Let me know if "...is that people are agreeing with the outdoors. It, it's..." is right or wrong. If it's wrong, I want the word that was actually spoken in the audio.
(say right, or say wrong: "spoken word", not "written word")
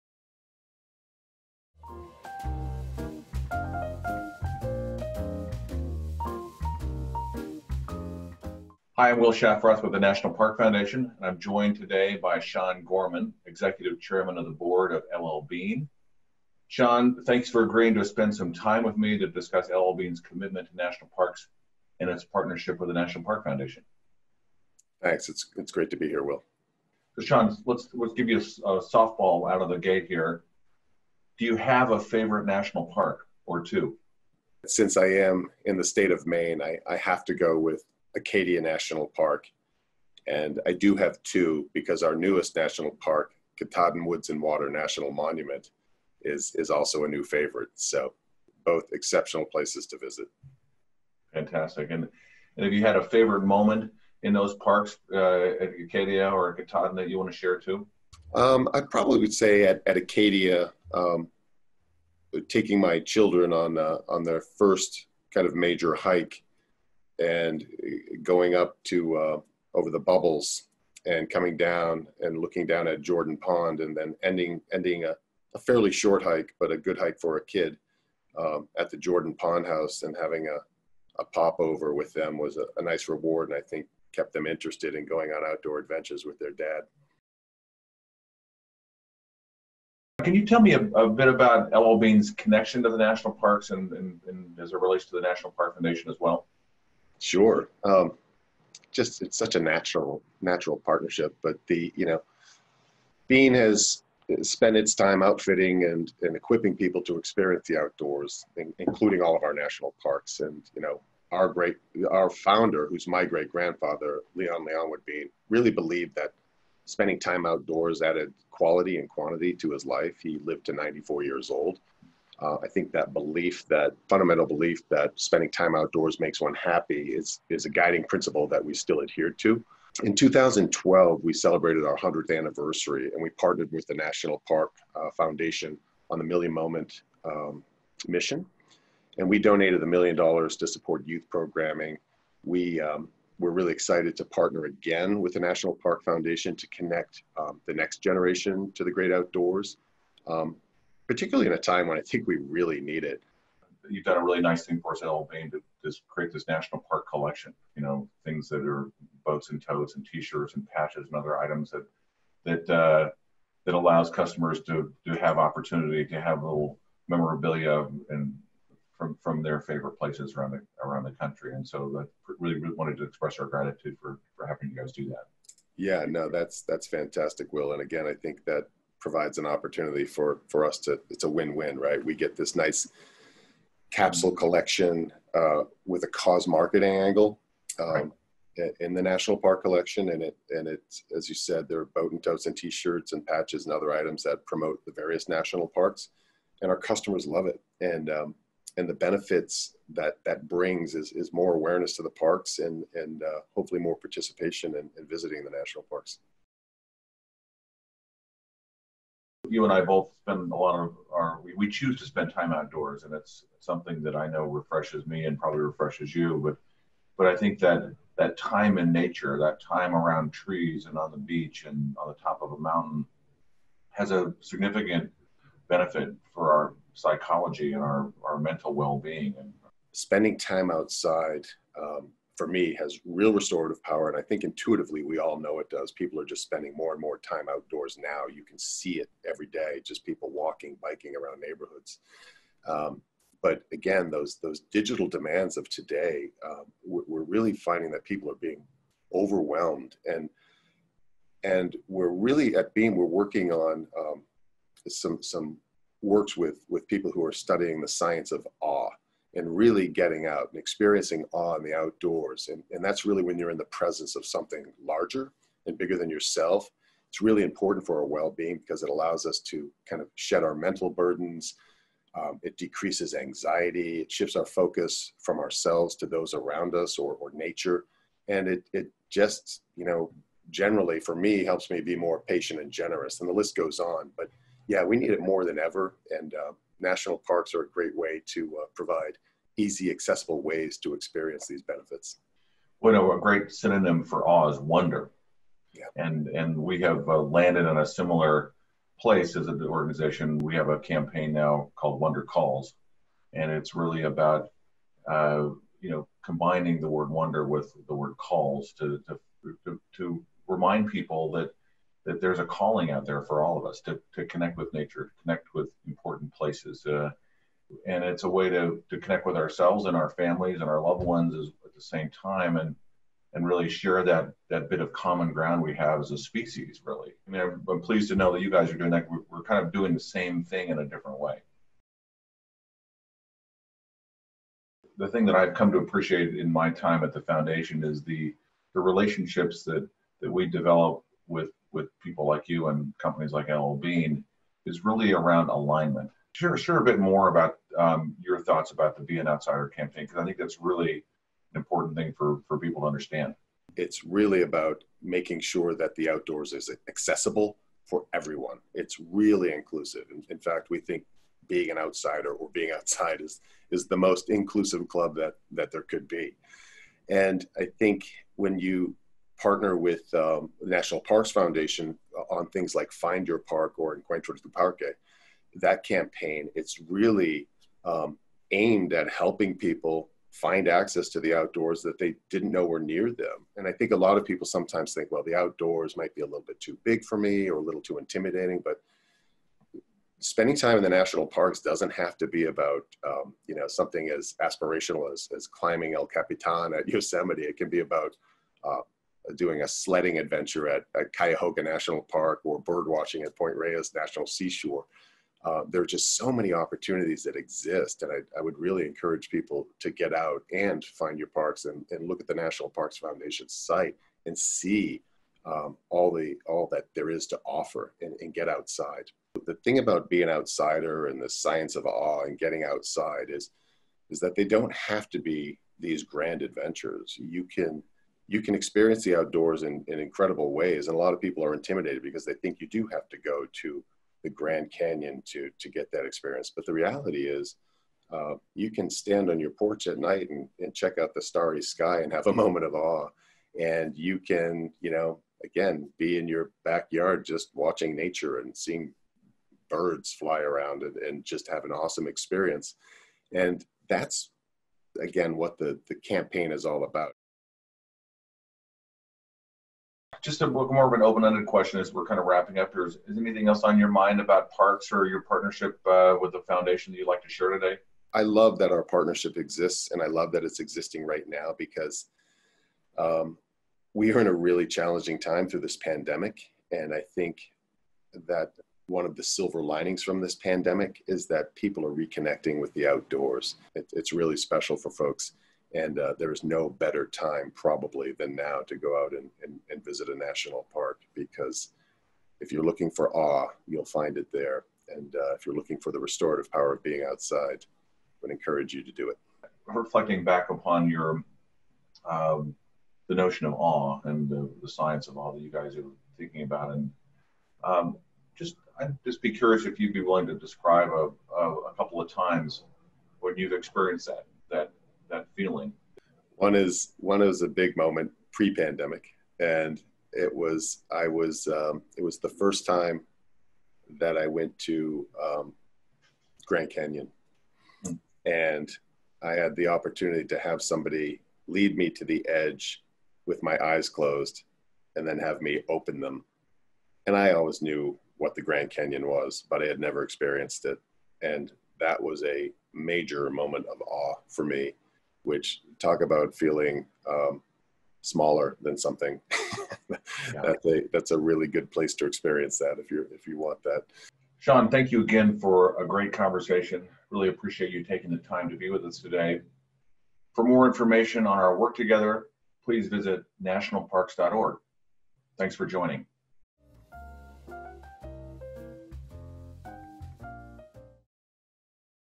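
wrong: "reconnecting", not "agreeing".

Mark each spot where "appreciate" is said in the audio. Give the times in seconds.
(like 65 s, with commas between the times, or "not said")
335 s, 557 s.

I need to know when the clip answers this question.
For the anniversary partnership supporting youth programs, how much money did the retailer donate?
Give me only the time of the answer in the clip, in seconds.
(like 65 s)
139 s.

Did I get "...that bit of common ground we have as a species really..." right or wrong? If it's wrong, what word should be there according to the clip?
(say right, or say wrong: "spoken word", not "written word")
right.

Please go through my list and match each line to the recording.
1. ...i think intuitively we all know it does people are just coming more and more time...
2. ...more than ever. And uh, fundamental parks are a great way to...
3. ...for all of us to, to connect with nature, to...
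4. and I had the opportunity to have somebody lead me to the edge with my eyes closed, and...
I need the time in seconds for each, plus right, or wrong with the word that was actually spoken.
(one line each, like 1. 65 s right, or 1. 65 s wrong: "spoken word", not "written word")
1. 234 s wrong: "spending", not "coming"
2. 285 s wrong: "national", not "fundamental"
3. 313 s right
4. 528 s right.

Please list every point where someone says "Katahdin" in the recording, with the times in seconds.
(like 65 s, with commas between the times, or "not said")
43 s, 56 s.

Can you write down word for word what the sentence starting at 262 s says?
And, and that's really when you're in the presence of something larger and bigger than yourself.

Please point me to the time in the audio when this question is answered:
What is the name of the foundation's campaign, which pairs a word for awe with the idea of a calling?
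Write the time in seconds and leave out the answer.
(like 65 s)
302 s.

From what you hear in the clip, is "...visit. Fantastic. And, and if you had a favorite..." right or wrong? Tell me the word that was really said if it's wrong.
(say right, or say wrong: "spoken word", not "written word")
right.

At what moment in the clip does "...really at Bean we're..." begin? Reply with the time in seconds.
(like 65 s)
252 s.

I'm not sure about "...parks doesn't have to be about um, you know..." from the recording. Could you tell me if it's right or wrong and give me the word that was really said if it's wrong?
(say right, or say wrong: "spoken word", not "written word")
right.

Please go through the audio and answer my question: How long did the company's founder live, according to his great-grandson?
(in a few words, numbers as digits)
94 years.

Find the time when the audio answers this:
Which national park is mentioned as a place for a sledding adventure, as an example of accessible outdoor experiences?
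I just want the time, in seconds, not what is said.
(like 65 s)
401 s.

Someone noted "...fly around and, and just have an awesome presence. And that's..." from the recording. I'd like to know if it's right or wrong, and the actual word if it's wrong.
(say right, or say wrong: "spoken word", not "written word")
wrong: "experience", not "presence".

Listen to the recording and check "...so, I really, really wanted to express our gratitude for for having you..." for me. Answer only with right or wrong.
right.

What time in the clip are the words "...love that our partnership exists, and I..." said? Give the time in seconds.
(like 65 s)
468 s.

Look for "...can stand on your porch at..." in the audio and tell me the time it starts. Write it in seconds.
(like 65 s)
438 s.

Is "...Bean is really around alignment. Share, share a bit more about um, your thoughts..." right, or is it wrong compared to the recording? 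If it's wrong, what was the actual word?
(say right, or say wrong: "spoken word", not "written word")
right.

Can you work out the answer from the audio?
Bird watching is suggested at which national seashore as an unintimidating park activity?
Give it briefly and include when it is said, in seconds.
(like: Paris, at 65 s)
Point Reyes, at 403 s.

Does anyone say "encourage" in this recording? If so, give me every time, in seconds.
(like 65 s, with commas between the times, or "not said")
408 s, 498 s.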